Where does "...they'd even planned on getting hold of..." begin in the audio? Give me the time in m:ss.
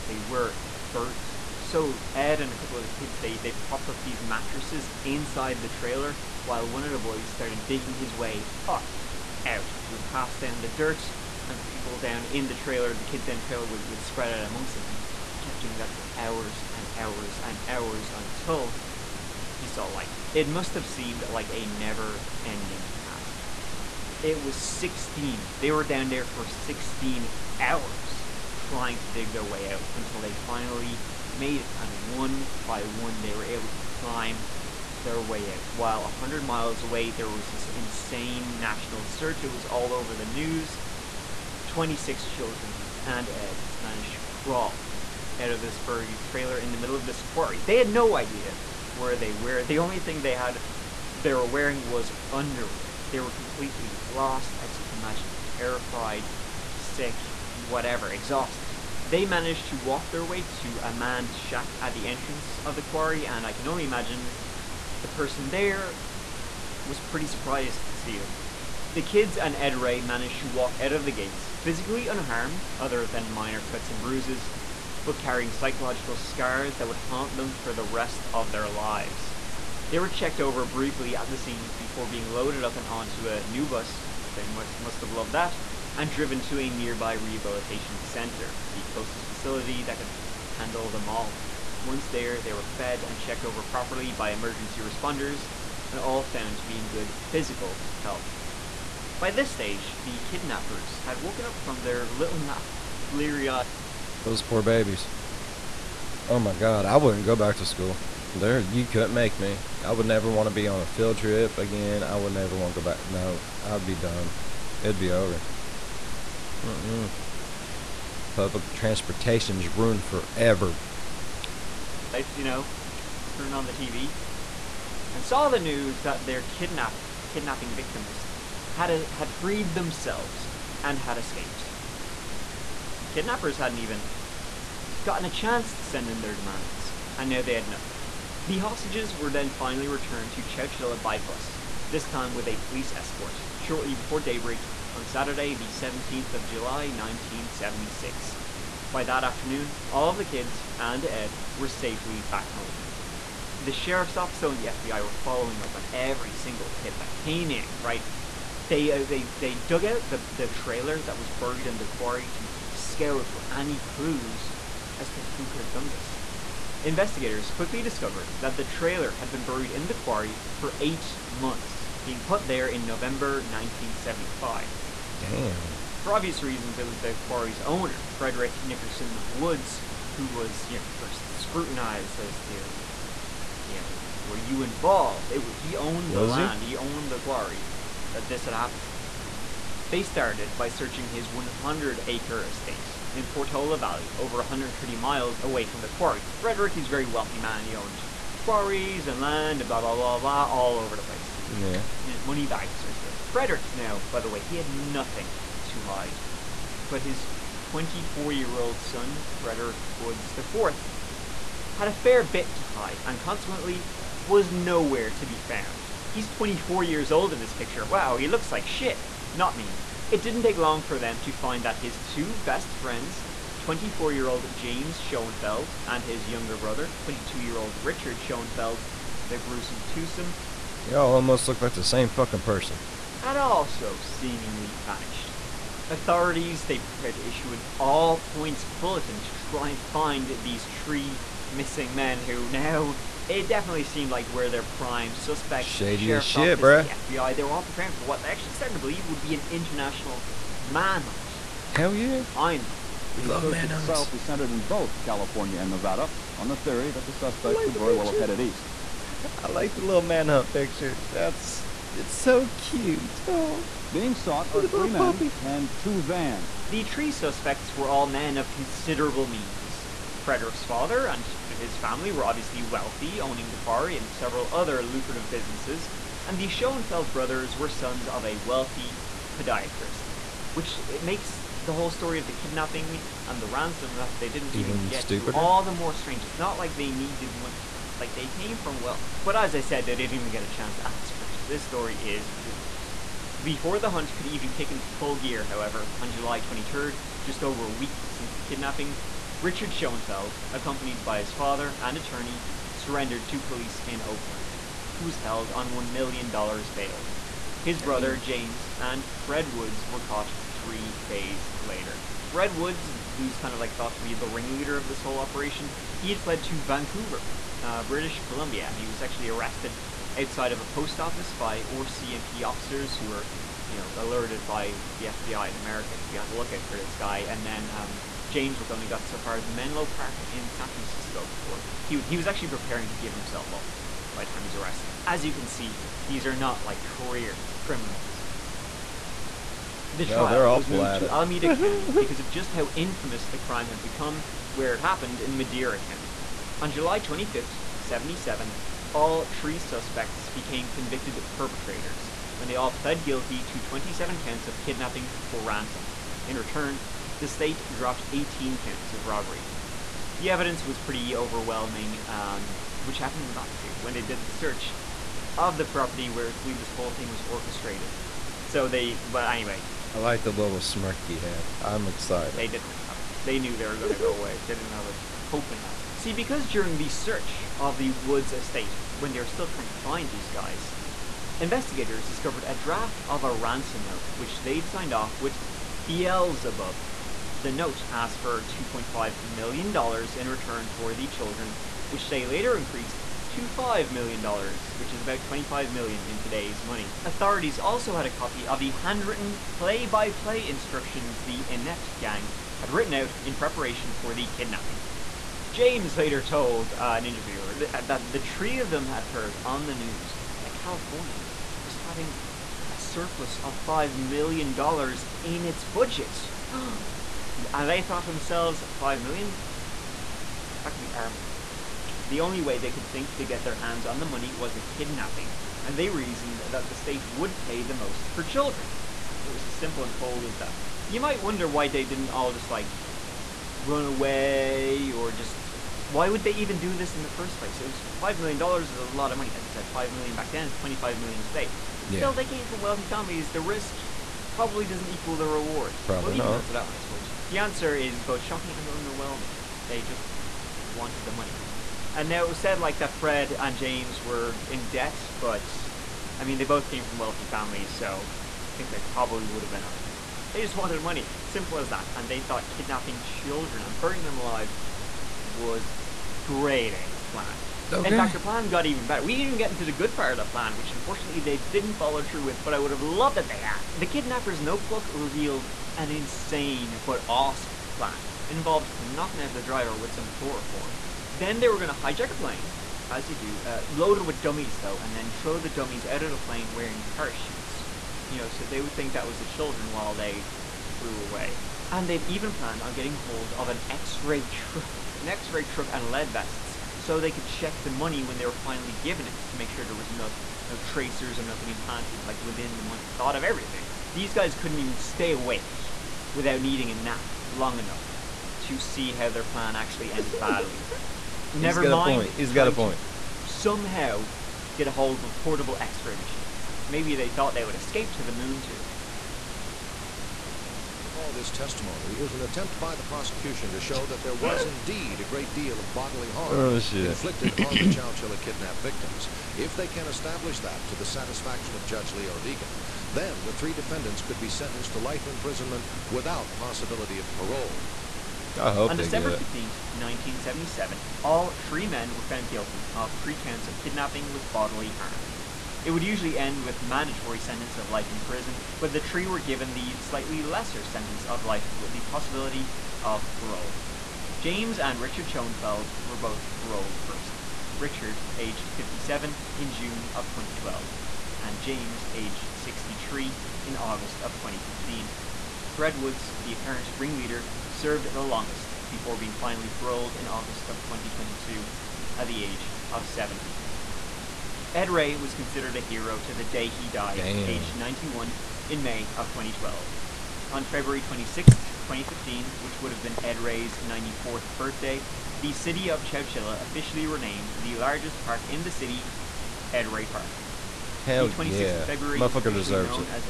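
8:11.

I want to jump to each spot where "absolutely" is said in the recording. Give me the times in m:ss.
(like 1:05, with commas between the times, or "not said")
not said.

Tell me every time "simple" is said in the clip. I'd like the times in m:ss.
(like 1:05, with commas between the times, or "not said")
7:09, 7:41.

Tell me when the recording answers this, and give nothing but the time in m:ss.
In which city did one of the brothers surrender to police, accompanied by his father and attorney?
5:04.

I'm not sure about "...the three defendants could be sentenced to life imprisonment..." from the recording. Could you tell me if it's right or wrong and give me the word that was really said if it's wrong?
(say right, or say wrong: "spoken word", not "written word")
right.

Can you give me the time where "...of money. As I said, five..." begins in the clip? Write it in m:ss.
7:19.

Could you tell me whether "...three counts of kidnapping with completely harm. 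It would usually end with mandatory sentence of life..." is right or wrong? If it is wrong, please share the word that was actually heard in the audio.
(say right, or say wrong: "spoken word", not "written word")
wrong: "bodily", not "completely".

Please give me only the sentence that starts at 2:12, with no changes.
The kidnappers hadn't even gotten a chance to send in their demands, and now they had nothing.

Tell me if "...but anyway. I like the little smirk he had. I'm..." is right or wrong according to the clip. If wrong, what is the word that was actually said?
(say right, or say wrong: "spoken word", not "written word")
right.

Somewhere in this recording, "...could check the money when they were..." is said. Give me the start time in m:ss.
8:17.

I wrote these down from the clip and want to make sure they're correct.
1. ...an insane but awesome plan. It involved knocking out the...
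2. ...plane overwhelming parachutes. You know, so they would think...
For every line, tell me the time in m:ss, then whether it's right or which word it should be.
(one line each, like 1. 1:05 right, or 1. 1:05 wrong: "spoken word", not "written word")
1. 7:55 right
2. 8:06 wrong: "wearing", not "overwhelming".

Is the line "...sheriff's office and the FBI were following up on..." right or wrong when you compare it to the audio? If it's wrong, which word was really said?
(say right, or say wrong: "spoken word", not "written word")
right.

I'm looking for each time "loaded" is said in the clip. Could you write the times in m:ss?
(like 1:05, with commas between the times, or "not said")
1:22, 8:03.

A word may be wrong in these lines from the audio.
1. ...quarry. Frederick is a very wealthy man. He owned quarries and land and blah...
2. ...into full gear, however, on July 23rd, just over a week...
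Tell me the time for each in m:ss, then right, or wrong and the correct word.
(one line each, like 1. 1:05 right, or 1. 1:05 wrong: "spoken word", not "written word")
1. 3:15 right
2. 4:54 right.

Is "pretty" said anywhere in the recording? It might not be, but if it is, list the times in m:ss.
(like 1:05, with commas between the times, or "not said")
1:06, 6:00.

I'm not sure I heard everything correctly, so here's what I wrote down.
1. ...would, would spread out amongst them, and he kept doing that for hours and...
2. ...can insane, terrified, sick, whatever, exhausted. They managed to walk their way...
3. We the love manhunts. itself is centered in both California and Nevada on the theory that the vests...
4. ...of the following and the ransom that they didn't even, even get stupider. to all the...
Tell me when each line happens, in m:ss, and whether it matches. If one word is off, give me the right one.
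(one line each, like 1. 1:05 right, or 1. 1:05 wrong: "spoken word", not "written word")
1. 0:13 right
2. 0:54 wrong: "imagine", not "insane"
3. 4:13 wrong: "suspects", not "vests"
4. 4:42 wrong: "kidnapping", not "following".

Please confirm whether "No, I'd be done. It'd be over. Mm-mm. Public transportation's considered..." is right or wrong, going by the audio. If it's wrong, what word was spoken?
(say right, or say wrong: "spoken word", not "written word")
wrong: "ruined", not "considered".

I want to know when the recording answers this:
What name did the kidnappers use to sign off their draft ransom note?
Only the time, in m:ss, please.
6:25.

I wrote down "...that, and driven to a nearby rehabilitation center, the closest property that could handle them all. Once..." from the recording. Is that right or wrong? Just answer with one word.
wrong.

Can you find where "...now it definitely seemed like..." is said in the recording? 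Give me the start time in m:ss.
4:02.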